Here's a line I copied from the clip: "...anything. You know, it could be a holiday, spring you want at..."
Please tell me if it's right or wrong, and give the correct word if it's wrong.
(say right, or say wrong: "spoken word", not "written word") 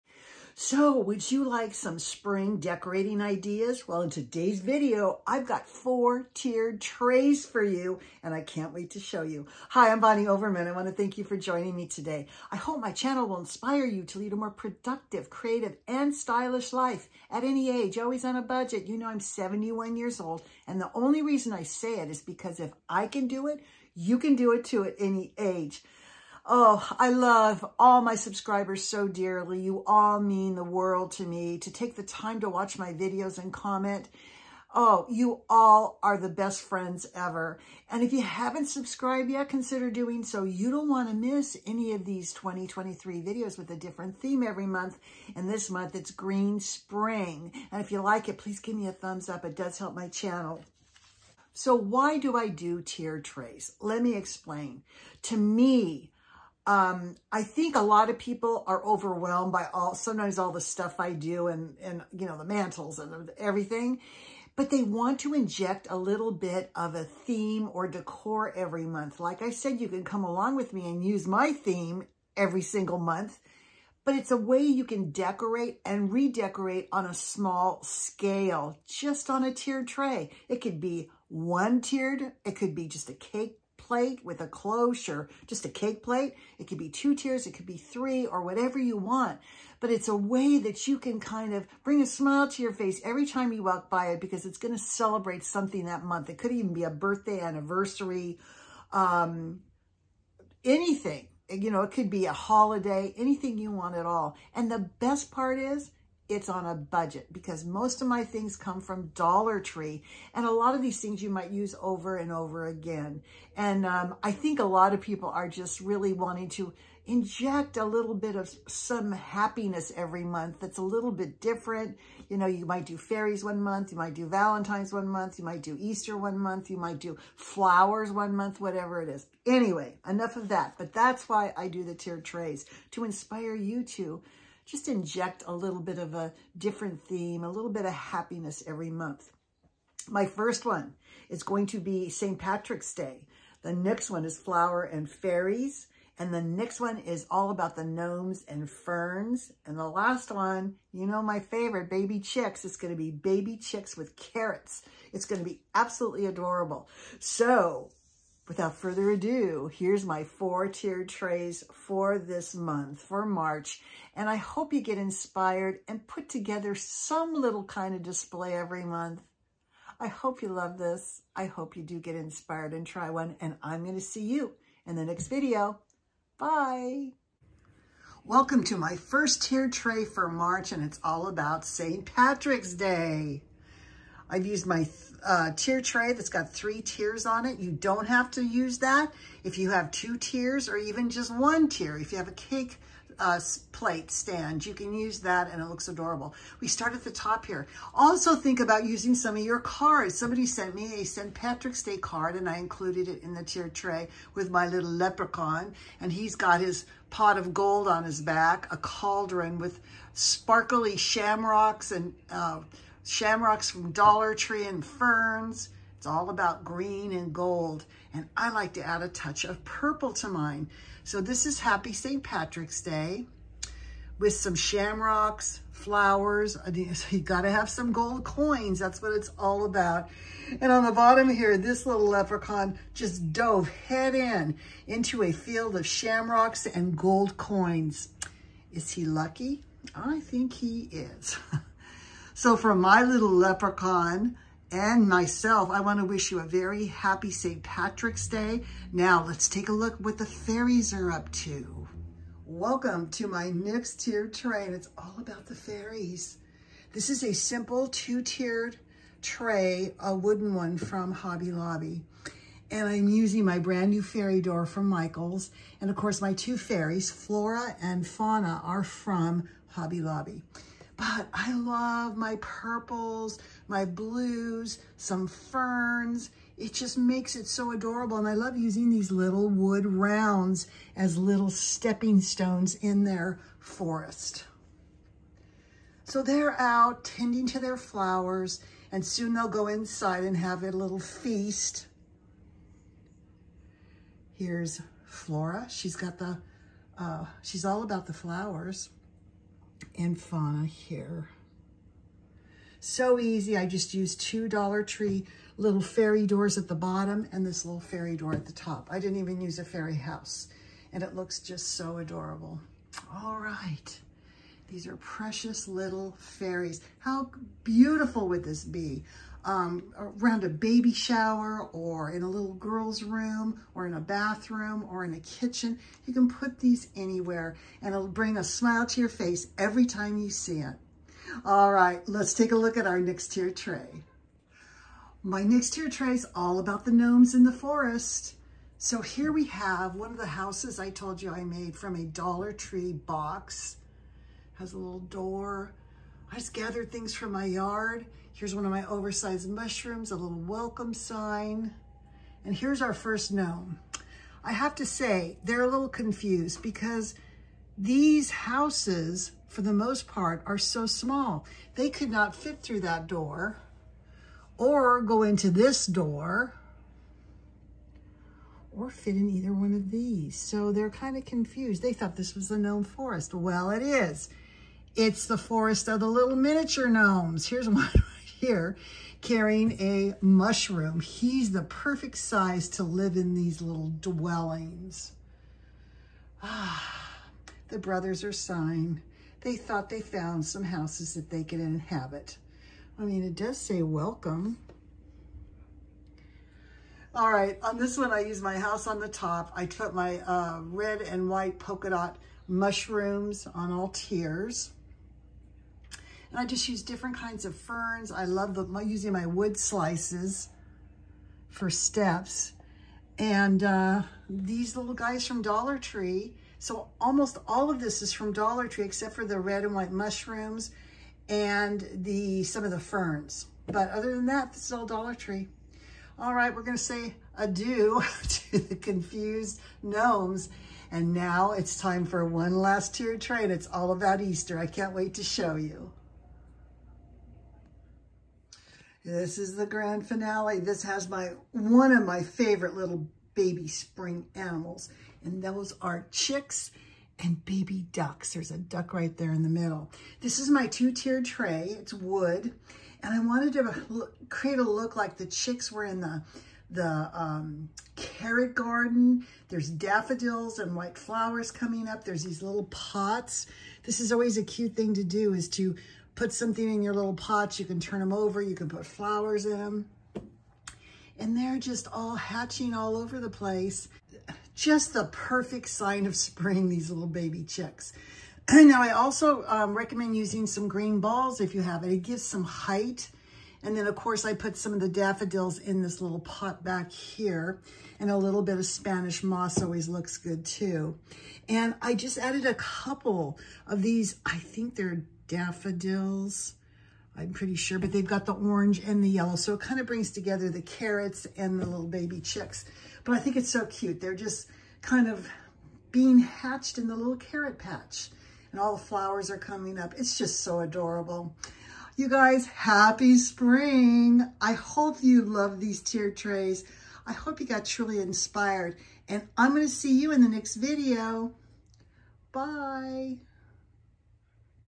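wrong: "anything", not "spring".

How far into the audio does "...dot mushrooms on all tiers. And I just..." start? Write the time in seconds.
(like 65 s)
401 s.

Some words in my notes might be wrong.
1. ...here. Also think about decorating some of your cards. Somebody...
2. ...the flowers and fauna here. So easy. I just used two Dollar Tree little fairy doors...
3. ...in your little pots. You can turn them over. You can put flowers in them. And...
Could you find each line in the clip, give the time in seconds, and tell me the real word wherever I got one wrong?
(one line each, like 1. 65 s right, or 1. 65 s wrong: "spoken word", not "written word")
1. 197 s wrong: "using", not "decorating"
2. 298 s right
3. 466 s right.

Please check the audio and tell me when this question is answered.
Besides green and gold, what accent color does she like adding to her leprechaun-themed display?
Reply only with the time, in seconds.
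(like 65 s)
219 s.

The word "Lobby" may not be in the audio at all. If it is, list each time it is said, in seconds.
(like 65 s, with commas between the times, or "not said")
261 s, 269 s.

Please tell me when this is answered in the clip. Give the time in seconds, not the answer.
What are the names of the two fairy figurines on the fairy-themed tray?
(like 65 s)
267 s.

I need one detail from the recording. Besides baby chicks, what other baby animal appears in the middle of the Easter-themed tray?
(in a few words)
baby ducks.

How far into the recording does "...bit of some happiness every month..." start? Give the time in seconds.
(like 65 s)
118 s.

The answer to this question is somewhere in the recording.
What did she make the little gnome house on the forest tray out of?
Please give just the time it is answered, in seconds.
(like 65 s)
341 s.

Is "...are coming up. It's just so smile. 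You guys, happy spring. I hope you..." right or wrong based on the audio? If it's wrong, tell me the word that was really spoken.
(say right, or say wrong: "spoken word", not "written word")
wrong: "adorable", not "smile".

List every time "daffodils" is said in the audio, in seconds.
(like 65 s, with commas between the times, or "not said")
459 s, 484 s, 495 s.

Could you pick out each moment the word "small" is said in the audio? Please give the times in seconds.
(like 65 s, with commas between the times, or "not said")
77 s, 360 s.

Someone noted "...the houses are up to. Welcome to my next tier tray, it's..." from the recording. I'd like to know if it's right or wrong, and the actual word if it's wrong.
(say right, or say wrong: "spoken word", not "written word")
wrong: "fairies", not "houses".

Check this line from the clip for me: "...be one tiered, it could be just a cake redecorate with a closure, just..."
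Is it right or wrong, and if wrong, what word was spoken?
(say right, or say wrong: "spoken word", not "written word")
wrong: "plate", not "redecorate".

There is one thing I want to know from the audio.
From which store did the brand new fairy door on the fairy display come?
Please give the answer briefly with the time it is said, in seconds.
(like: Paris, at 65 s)
Michaels, at 264 s.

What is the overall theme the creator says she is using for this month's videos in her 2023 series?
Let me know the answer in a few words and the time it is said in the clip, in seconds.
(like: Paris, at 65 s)
Green Spring, at 46 s.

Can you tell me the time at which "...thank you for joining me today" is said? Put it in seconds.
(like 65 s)
10 s.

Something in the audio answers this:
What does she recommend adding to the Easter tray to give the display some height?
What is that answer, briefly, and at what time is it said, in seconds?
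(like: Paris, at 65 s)
green balls, at 480 s.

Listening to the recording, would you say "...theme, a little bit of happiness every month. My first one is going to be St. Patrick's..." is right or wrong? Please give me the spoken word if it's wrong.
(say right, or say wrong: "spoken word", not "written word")
right.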